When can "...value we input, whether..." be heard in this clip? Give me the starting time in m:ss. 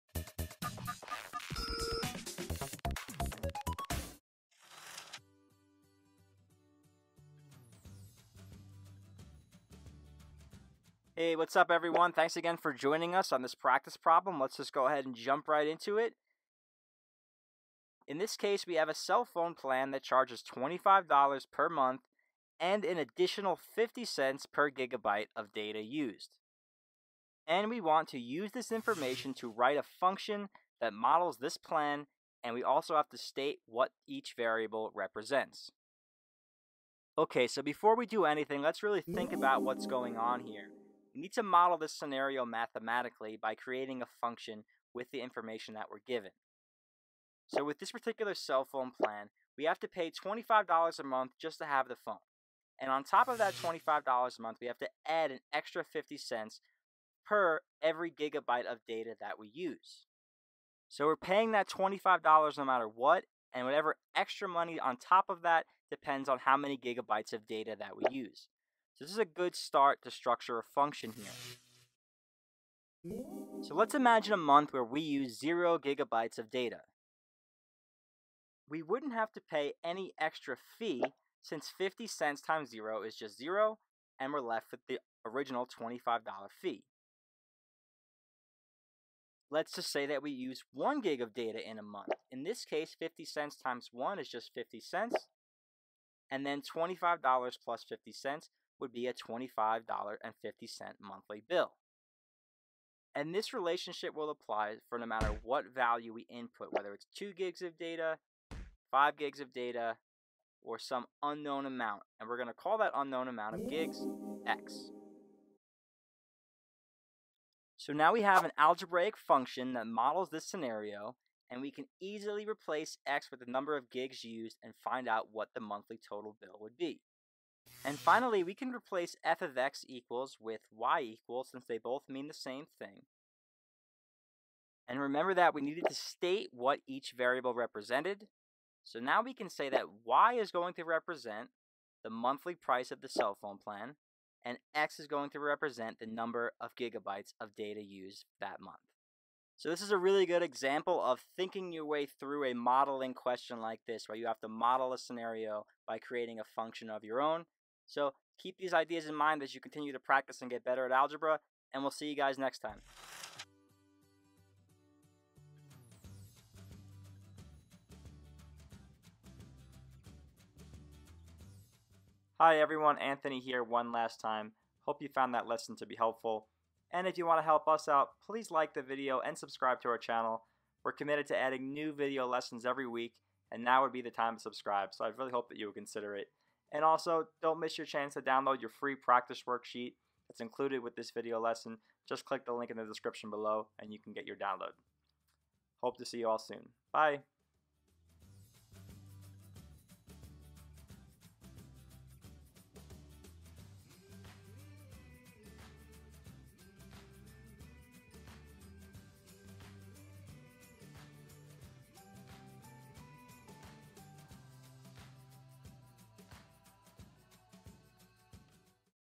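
1:45.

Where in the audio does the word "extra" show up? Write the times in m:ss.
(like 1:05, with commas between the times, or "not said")
0:55, 1:04, 1:20.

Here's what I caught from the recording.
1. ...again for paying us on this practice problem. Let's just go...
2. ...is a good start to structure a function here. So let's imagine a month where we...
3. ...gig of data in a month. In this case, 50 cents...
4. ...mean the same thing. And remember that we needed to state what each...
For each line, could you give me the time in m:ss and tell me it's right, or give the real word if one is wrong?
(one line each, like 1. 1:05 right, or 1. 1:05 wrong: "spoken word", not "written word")
1. 0:12 wrong: "joining", not "paying"
2. 1:09 right
3. 1:31 right
4. 2:12 right.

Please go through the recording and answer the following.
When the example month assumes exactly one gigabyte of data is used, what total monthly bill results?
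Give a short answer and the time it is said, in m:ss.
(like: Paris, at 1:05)
$25.50, at 1:39.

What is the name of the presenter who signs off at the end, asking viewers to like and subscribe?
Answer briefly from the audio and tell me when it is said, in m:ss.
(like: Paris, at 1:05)
Anthony, at 2:52.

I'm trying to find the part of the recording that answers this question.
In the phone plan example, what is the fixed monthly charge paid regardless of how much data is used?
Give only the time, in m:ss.
0:20.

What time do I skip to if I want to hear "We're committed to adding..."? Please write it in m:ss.
3:00.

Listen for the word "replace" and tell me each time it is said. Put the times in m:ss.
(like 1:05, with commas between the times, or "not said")
2:02, 2:08.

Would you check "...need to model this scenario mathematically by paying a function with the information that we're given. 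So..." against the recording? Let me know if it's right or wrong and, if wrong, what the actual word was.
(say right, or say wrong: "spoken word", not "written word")
wrong: "creating", not "paying".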